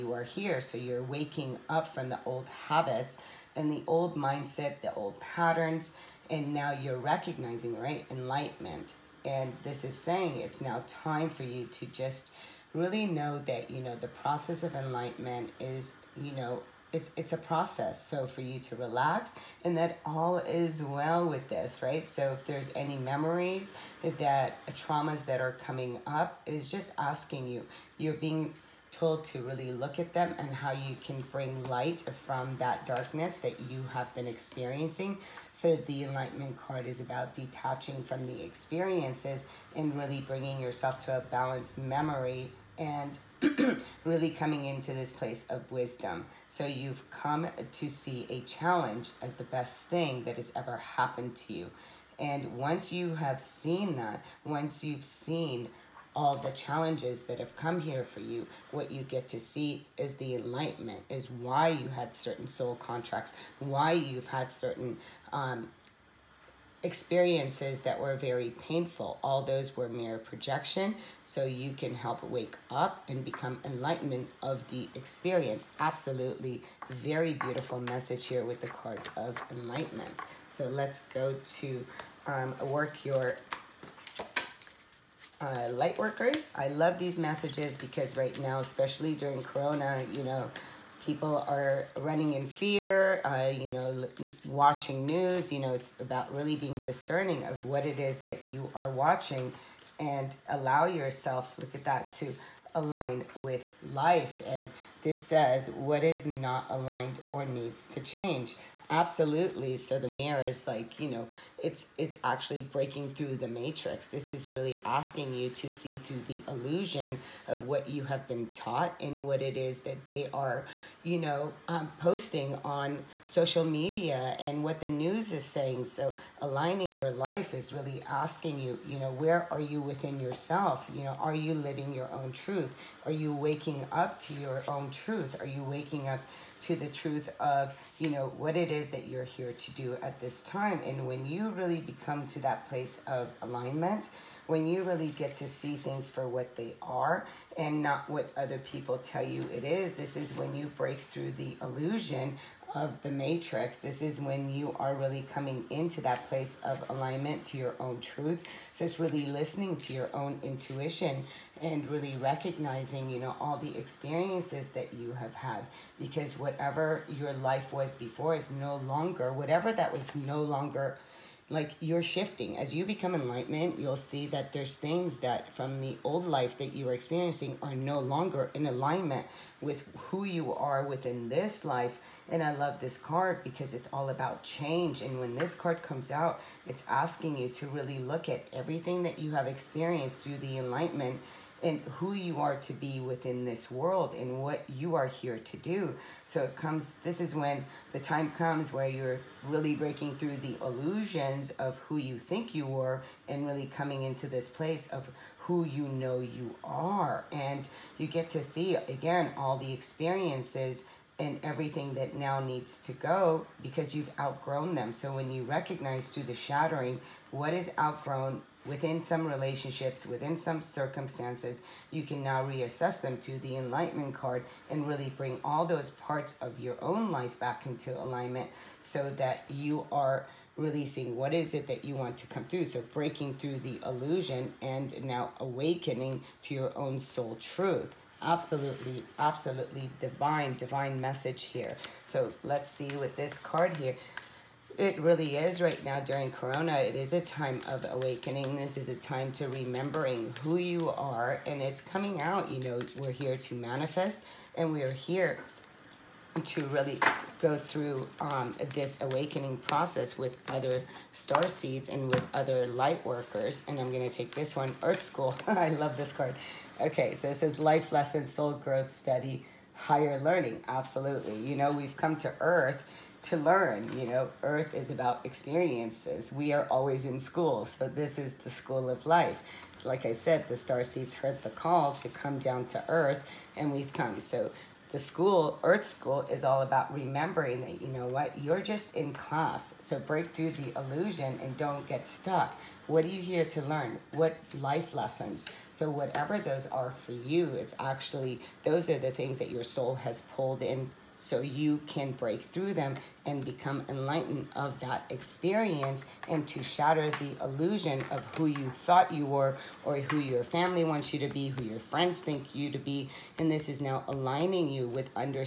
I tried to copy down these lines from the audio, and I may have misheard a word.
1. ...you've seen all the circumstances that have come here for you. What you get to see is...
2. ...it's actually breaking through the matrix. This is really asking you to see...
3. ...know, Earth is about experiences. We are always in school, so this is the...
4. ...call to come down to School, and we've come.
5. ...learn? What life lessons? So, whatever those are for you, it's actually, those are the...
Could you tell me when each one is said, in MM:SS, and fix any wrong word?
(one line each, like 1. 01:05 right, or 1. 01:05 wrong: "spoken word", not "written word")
1. 00:54 wrong: "challenges", not "circumstances"
2. 01:51 right
3. 04:34 right
4. 04:41 wrong: "Earth", not "School"
5. 04:53 right.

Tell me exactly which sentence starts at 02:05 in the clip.
So aligning your life is really asking you, you know, where are you within yourself?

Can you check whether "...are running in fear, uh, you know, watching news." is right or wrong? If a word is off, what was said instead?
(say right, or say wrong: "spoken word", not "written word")
right.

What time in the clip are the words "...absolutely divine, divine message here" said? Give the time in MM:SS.
03:59.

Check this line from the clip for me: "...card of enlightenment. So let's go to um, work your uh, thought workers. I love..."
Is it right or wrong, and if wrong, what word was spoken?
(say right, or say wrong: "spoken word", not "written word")
wrong: "light", not "thought".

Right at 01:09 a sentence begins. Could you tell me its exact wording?
All those were mere projection, so you can help wake up and become enlightenment of the experience.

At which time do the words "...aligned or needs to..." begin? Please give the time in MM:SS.
01:46.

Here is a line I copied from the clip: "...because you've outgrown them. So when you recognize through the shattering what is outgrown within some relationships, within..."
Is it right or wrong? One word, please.
right.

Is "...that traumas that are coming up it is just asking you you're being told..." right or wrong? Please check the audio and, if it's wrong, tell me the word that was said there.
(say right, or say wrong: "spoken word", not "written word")
right.